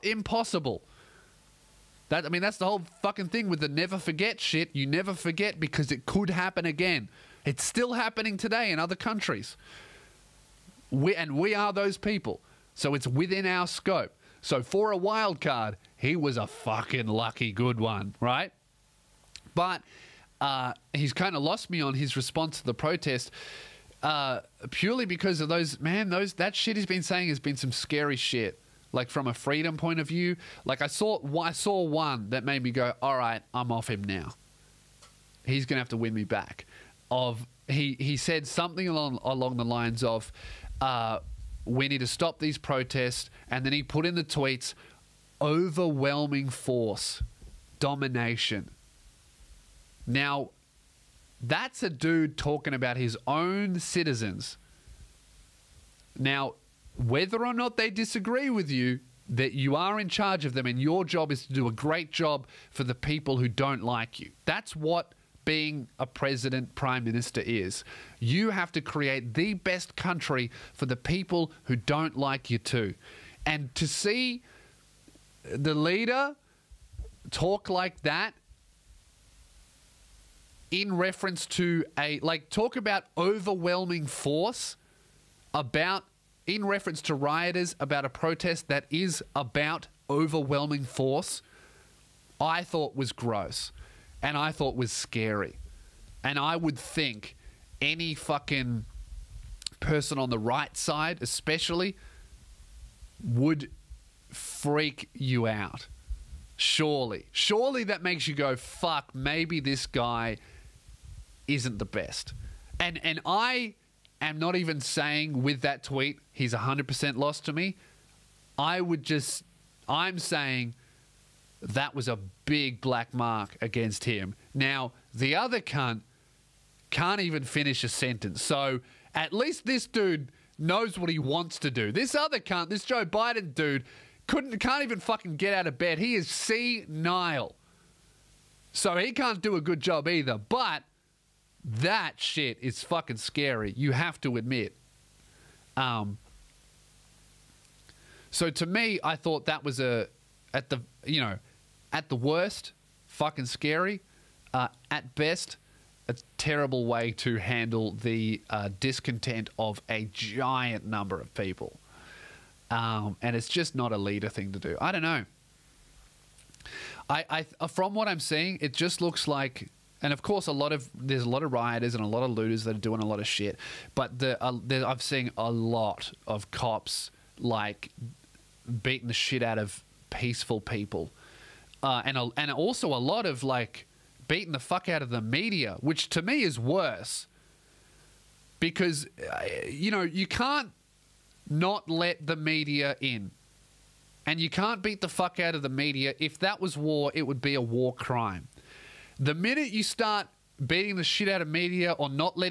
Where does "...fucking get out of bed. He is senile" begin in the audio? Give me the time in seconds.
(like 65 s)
134 s.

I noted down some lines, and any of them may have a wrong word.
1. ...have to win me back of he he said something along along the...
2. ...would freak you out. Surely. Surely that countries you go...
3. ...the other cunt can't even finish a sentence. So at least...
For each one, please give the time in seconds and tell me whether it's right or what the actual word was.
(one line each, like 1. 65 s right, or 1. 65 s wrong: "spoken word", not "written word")
1. 35 s right
2. 103 s wrong: "makes", not "countries"
3. 125 s right.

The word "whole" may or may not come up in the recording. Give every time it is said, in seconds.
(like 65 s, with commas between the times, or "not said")
2 s.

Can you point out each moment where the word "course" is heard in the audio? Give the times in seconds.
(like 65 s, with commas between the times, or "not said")
170 s.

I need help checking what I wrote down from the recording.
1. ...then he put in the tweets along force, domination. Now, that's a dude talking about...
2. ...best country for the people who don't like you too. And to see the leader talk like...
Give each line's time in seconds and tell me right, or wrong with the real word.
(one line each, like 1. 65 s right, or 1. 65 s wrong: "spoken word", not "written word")
1. 43 s wrong: "overwhelming", not "along"
2. 69 s right.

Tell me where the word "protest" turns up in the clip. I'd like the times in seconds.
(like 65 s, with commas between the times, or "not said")
22 s, 42 s, 88 s.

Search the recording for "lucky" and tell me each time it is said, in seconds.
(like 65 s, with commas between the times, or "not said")
17 s.